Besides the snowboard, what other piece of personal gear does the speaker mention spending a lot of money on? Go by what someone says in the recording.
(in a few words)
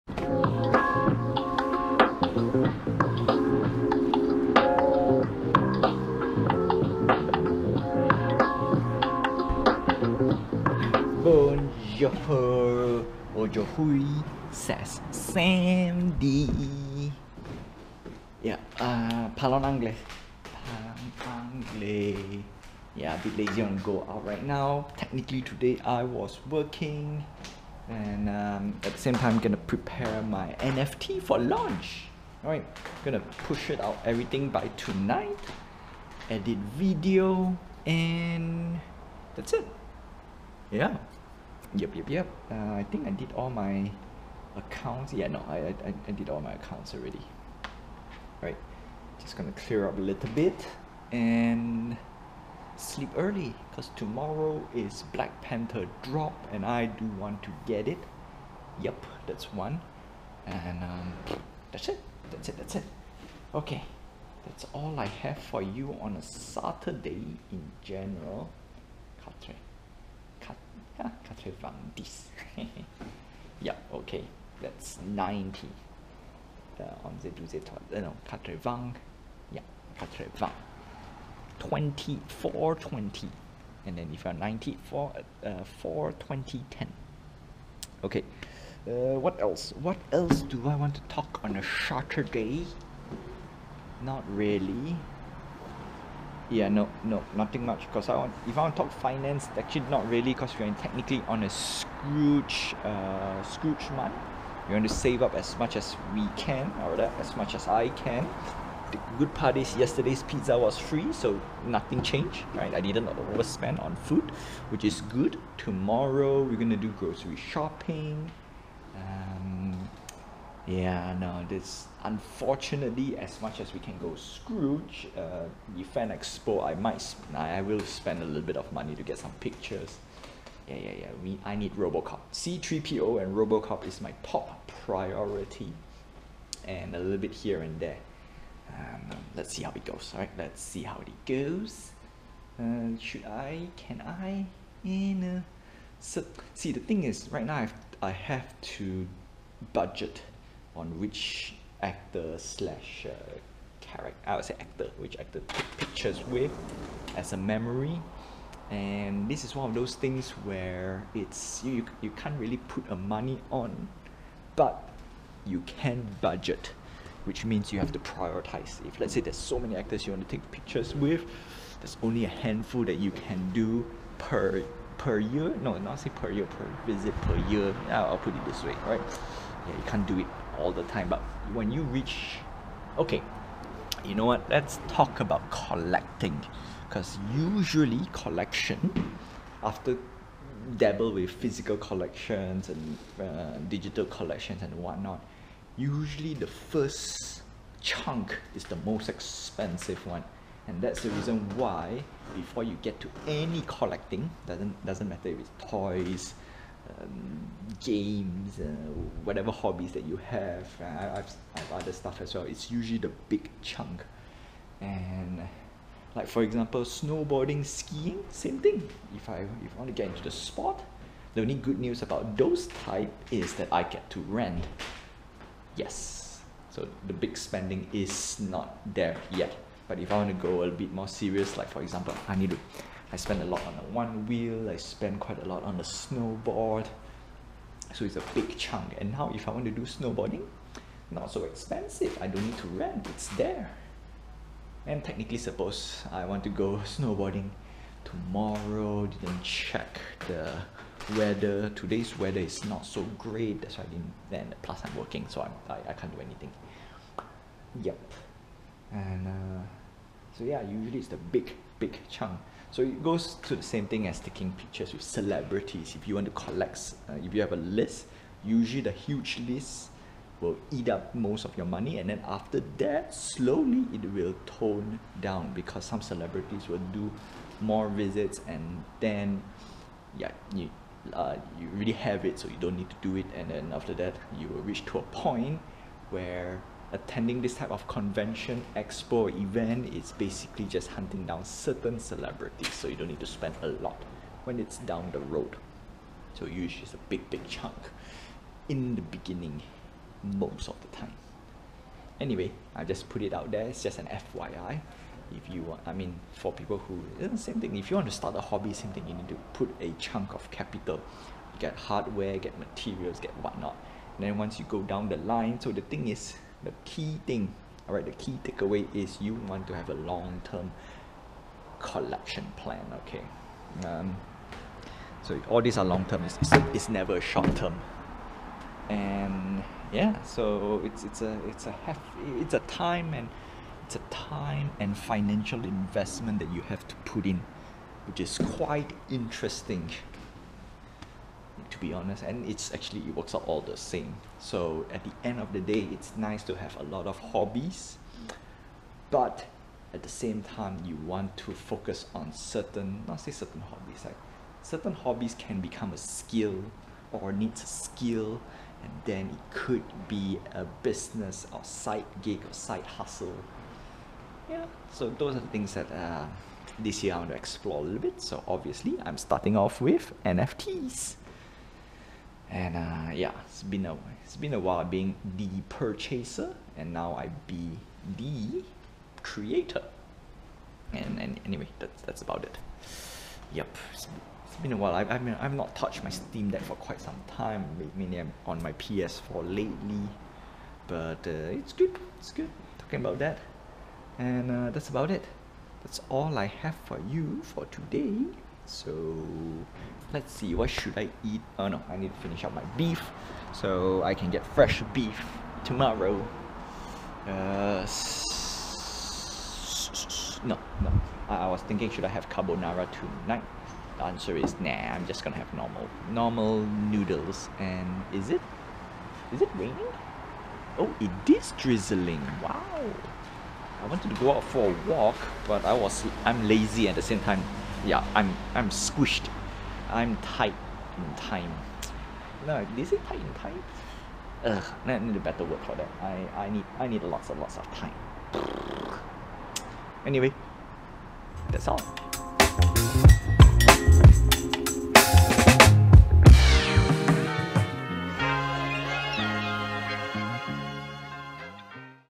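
one wheel.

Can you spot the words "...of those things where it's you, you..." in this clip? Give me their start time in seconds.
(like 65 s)
159 s.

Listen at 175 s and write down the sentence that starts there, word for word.
No, not say per year, per visit per year.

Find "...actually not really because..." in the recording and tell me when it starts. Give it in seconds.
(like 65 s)
99 s.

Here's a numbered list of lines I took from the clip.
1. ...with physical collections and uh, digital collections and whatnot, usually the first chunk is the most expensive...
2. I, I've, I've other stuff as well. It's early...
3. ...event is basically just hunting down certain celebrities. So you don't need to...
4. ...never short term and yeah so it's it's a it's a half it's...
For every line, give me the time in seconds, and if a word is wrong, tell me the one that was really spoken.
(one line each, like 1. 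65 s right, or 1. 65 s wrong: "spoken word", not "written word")
1. 191 s right
2. 210 s wrong: "usually", not "early"
3. 289 s right
4. 326 s right.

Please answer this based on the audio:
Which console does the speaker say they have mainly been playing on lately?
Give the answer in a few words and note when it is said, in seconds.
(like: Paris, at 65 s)
PS4, at 388 s.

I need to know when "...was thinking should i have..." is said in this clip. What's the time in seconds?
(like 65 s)
411 s.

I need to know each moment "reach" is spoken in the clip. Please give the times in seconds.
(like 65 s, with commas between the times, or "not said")
181 s, 284 s.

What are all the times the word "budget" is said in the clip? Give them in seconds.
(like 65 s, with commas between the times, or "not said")
149 s, 166 s.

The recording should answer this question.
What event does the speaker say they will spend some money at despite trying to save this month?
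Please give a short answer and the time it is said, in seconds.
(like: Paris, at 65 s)
Fan Expo, at 125 s.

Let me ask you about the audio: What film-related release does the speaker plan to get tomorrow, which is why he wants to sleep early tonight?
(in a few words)
Black Panther.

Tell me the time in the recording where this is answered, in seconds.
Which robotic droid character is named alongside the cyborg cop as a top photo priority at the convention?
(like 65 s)
132 s.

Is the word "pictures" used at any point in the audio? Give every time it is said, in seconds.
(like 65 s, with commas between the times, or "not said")
129 s, 155 s, 170 s, 264 s.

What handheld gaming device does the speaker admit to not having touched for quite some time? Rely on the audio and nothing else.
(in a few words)
Steam Deck.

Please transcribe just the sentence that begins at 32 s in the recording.
Alright, gonna push it out everything by tonight, edit video and that's it.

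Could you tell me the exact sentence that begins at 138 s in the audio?
Um, let's see how it goes.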